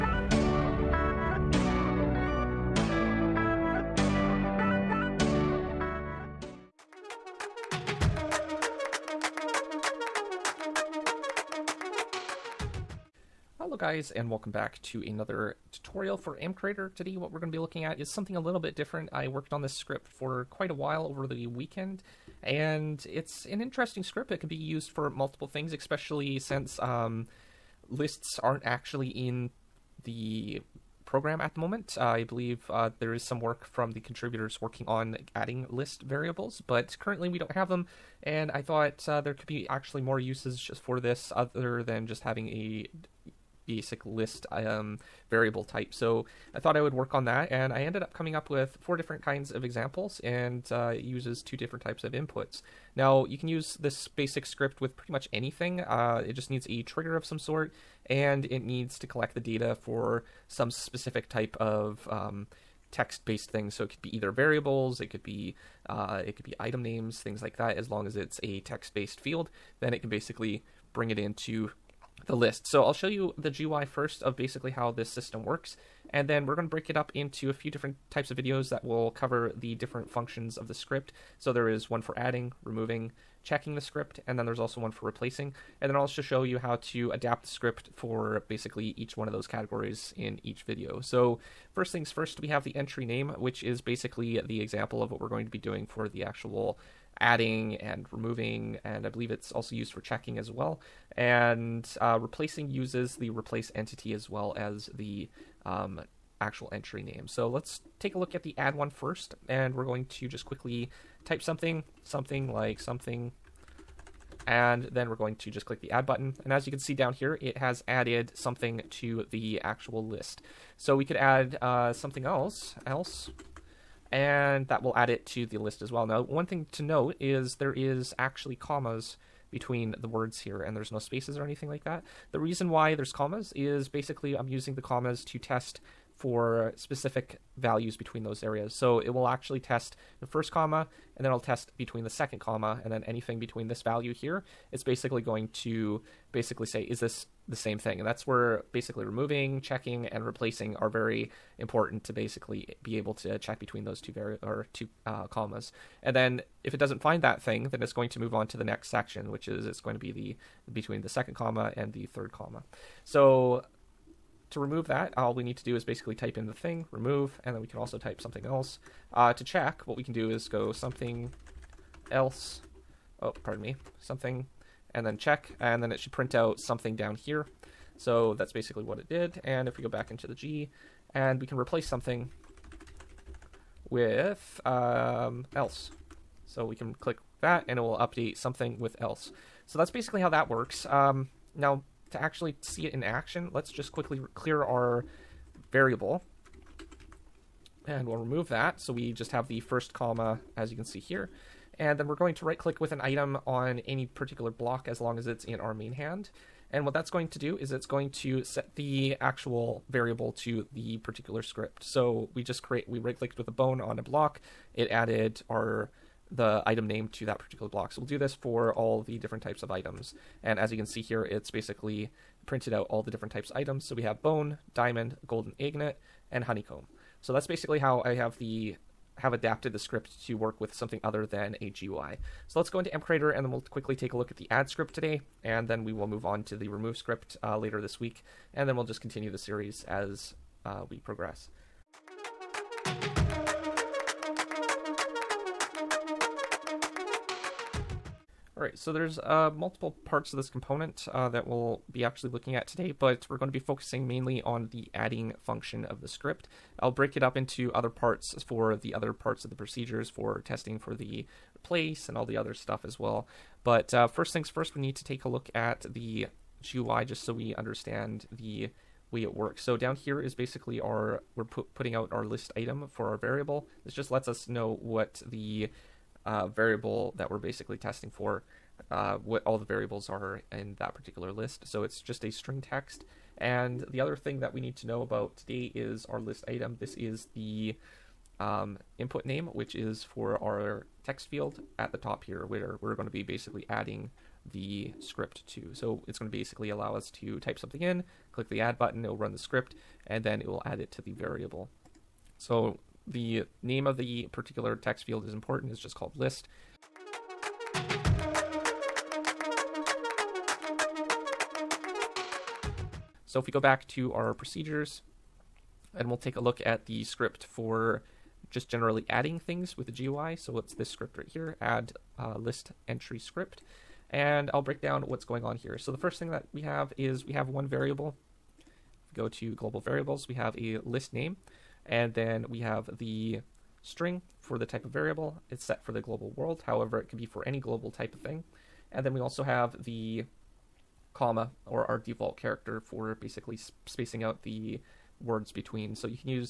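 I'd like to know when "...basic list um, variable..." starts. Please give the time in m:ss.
0:43.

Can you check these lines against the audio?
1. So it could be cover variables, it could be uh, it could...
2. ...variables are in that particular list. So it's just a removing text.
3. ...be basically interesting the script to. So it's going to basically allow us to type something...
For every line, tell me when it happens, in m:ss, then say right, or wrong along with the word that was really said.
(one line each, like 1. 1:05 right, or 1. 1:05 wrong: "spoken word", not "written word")
1. 1:03 wrong: "either", not "cover"
2. 4:39 wrong: "string", not "removing"
3. 4:53 wrong: "adding", not "interesting".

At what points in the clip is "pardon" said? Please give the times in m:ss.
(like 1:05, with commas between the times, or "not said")
2:53.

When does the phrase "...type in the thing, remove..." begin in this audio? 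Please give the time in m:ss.
2:46.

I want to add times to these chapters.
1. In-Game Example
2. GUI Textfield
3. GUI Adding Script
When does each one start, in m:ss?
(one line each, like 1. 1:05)
1. 0:06
2. 4:01
3. 5:06.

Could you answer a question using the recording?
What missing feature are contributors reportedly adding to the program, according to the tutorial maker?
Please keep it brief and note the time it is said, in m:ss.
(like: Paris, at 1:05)
List variables, at 0:35.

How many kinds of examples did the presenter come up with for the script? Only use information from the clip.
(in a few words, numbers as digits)
4.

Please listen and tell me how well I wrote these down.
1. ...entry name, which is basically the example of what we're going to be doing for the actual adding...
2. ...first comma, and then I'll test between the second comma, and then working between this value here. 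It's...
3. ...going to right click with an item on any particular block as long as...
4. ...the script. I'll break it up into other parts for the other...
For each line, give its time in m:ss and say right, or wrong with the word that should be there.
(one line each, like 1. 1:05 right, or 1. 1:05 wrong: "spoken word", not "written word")
1. 1:32 right
2. 2:20 wrong: "anything", not "working"
3. 3:22 right
4. 4:15 right.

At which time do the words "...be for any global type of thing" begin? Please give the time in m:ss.
5:37.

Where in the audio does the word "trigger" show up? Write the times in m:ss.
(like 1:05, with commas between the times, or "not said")
0:56.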